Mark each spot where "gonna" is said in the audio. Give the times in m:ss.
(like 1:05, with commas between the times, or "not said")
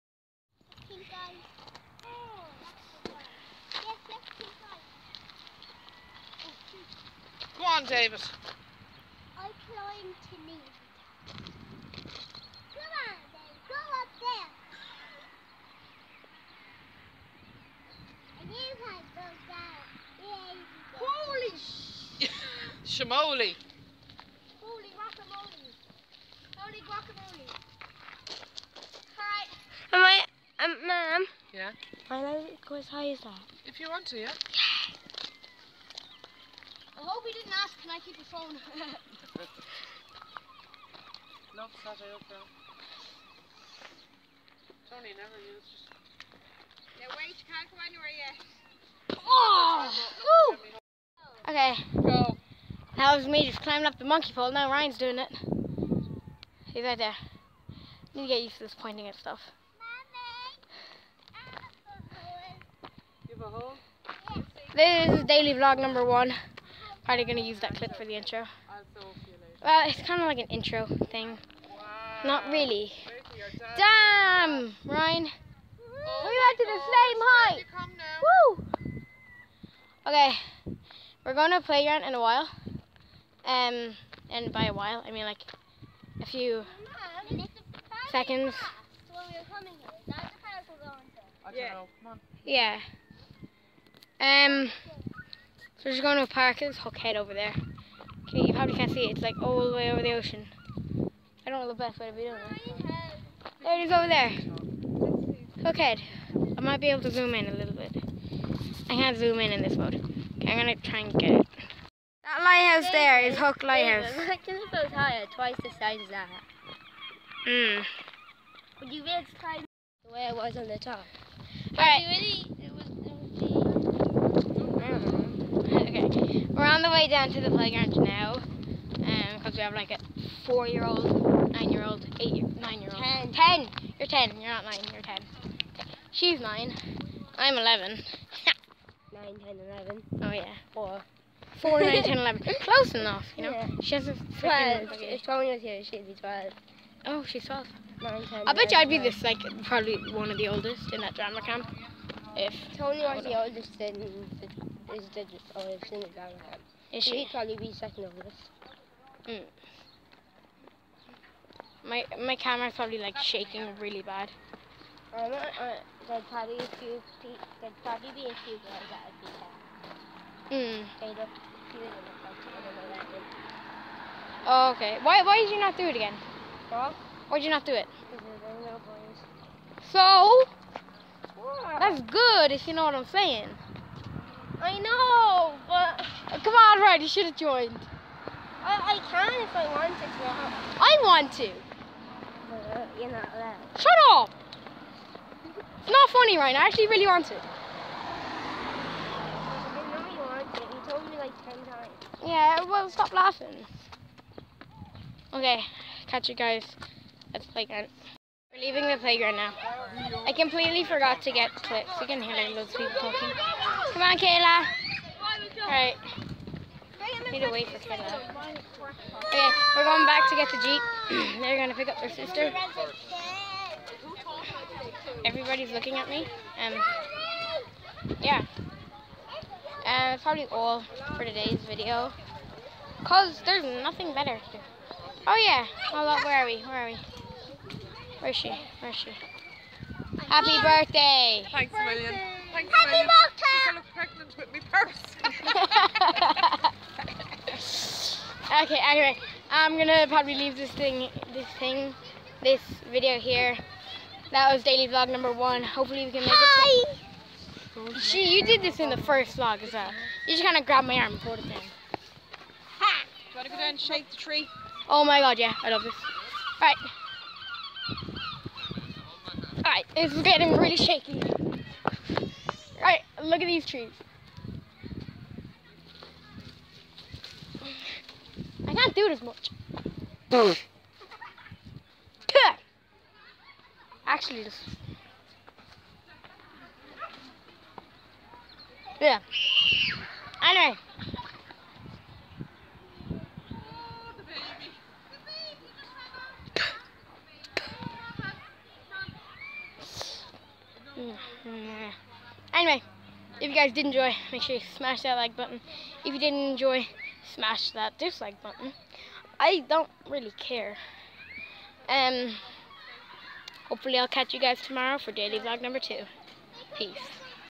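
4:09.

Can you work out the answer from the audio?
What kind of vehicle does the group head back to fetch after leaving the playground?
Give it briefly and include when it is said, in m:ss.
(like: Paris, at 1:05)
Jeep, at 3:40.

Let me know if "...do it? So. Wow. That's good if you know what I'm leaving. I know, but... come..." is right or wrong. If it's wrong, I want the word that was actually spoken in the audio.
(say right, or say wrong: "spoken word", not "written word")
wrong: "saying", not "leaving".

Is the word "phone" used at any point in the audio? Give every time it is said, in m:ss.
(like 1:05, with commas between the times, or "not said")
0:38.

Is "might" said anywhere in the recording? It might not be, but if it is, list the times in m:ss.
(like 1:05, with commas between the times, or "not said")
1:46.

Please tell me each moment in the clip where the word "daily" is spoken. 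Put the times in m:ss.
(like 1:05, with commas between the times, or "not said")
1:05, 4:14, 5:15.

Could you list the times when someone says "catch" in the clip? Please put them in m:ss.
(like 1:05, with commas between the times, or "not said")
3:26, 5:14.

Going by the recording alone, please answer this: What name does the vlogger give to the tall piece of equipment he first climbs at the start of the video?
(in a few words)
monkey pole.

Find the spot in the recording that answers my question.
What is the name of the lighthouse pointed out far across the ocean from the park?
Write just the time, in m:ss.
1:53.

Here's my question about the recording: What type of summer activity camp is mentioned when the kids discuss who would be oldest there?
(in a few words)
drama camp.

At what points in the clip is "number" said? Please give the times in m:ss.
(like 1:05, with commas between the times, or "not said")
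1:05, 4:15, 5:15.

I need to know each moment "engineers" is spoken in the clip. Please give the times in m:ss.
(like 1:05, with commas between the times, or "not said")
not said.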